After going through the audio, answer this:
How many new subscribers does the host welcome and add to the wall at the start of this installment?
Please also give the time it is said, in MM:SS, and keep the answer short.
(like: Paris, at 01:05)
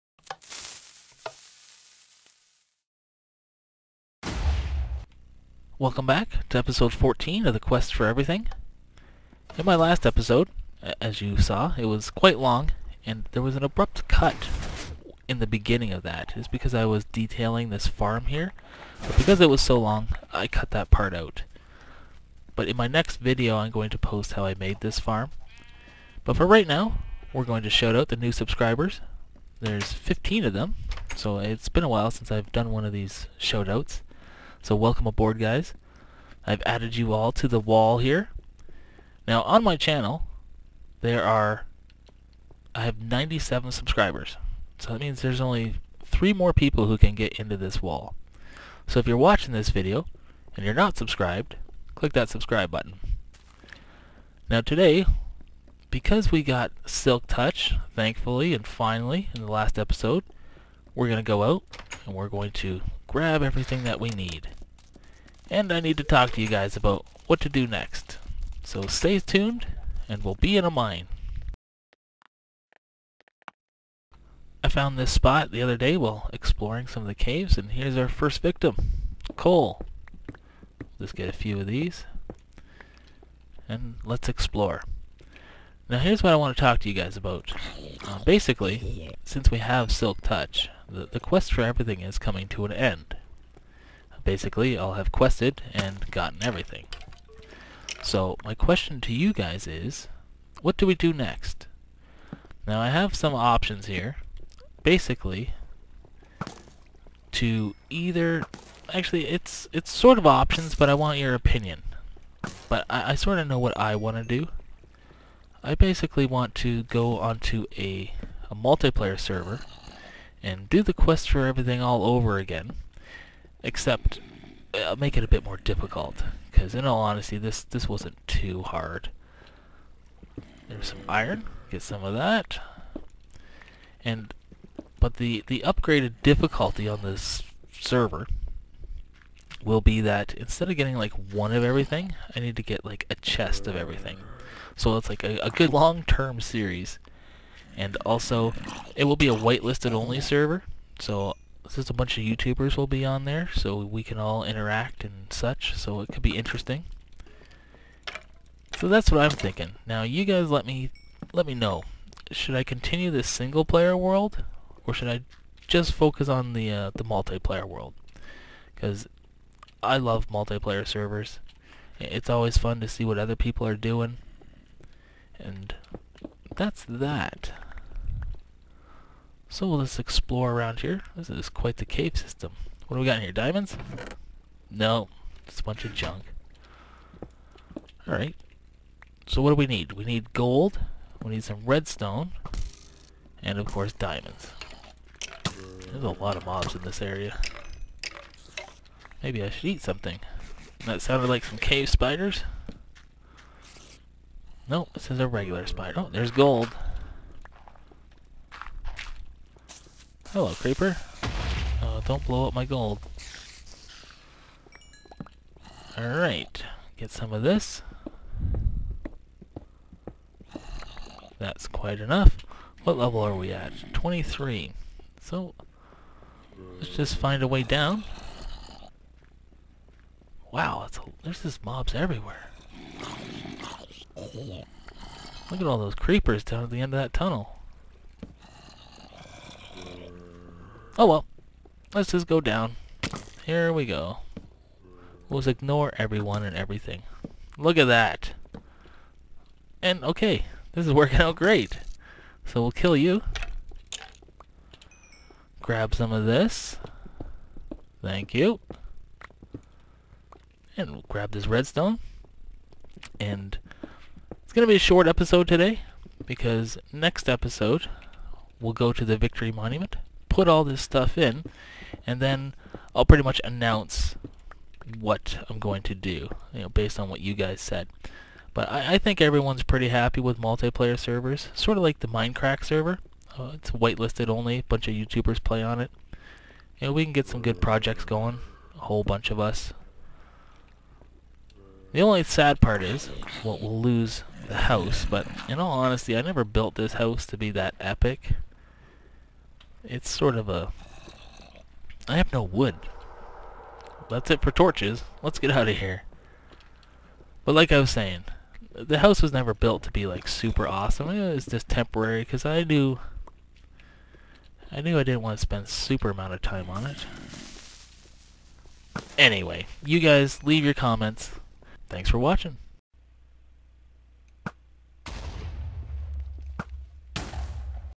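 15, at 00:29.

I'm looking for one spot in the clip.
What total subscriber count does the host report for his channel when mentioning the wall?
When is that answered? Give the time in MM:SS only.
00:43.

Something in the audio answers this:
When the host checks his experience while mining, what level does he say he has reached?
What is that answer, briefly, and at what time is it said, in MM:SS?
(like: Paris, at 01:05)
23, at 03:43.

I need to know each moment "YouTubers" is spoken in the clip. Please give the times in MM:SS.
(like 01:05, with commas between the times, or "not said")
02:32, 04:44.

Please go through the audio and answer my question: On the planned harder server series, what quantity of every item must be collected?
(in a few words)
a chest.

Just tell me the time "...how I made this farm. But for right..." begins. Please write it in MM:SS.
00:24.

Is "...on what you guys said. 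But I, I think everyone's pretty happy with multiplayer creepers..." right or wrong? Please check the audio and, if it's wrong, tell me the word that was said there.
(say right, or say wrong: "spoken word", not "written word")
wrong: "servers", not "creepers".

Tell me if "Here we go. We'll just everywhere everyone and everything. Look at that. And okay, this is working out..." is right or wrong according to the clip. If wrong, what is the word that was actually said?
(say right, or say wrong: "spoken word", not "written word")
wrong: "ignore", not "everywhere".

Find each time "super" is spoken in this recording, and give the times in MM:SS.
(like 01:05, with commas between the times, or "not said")
05:10, 05:15.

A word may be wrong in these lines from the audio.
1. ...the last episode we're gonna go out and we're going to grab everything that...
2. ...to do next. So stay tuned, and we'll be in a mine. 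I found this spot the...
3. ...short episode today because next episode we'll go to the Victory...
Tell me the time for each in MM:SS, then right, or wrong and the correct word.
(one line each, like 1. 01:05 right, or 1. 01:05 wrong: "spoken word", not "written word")
1. 00:59 right
2. 01:07 right
3. 04:24 right.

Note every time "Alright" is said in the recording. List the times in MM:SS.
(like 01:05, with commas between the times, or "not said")
03:08, 03:35.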